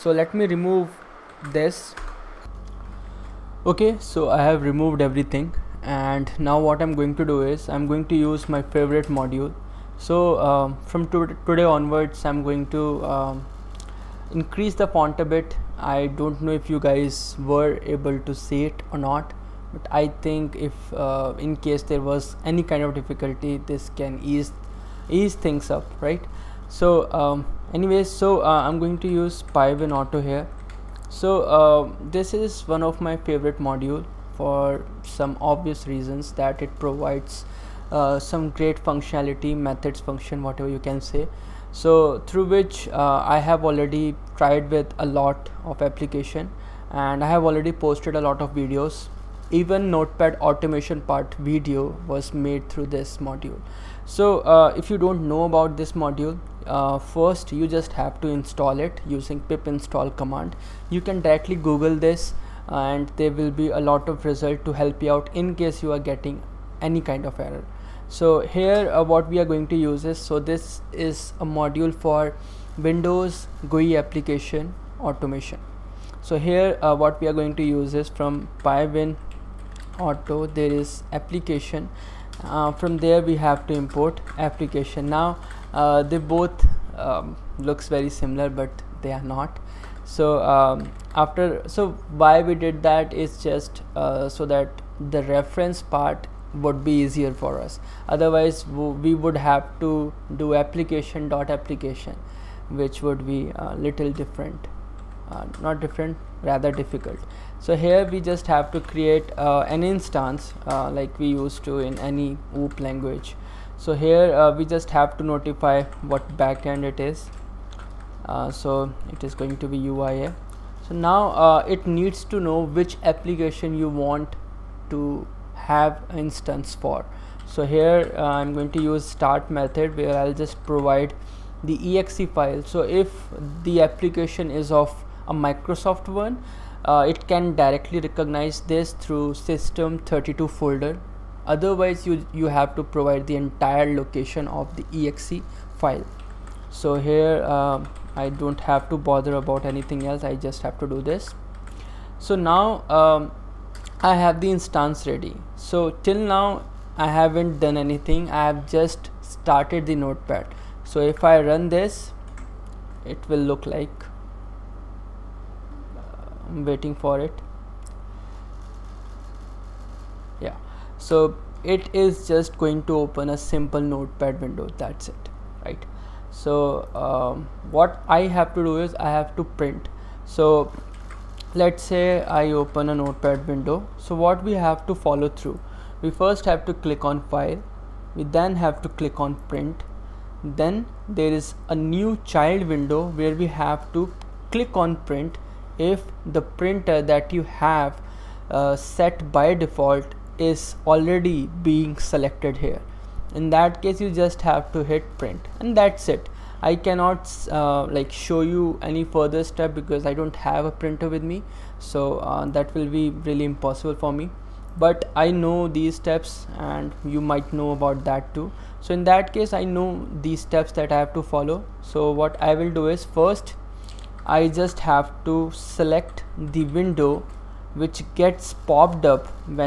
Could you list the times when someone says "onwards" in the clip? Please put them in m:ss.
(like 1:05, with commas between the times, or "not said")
0:11.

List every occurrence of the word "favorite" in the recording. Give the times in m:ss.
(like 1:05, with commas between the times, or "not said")
0:08, 0:33.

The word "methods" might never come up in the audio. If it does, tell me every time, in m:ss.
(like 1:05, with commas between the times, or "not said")
0:39, 2:09.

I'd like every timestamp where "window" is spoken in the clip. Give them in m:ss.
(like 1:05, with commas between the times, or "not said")
1:12, 2:54, 3:03, 3:12, 3:46.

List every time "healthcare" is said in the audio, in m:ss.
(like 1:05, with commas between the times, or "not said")
not said.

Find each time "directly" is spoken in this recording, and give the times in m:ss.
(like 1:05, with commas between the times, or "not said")
1:01, 2:17.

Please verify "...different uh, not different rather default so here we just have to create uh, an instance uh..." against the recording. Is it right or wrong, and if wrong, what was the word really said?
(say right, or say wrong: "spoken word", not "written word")
wrong: "difficult", not "default".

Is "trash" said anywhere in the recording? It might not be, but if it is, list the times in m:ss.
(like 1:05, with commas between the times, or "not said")
not said.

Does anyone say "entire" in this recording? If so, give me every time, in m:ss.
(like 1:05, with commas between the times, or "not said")
2:23.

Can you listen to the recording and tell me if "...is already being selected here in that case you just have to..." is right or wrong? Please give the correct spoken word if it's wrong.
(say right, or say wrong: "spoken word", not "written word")
right.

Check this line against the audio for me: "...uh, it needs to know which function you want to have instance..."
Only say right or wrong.
wrong.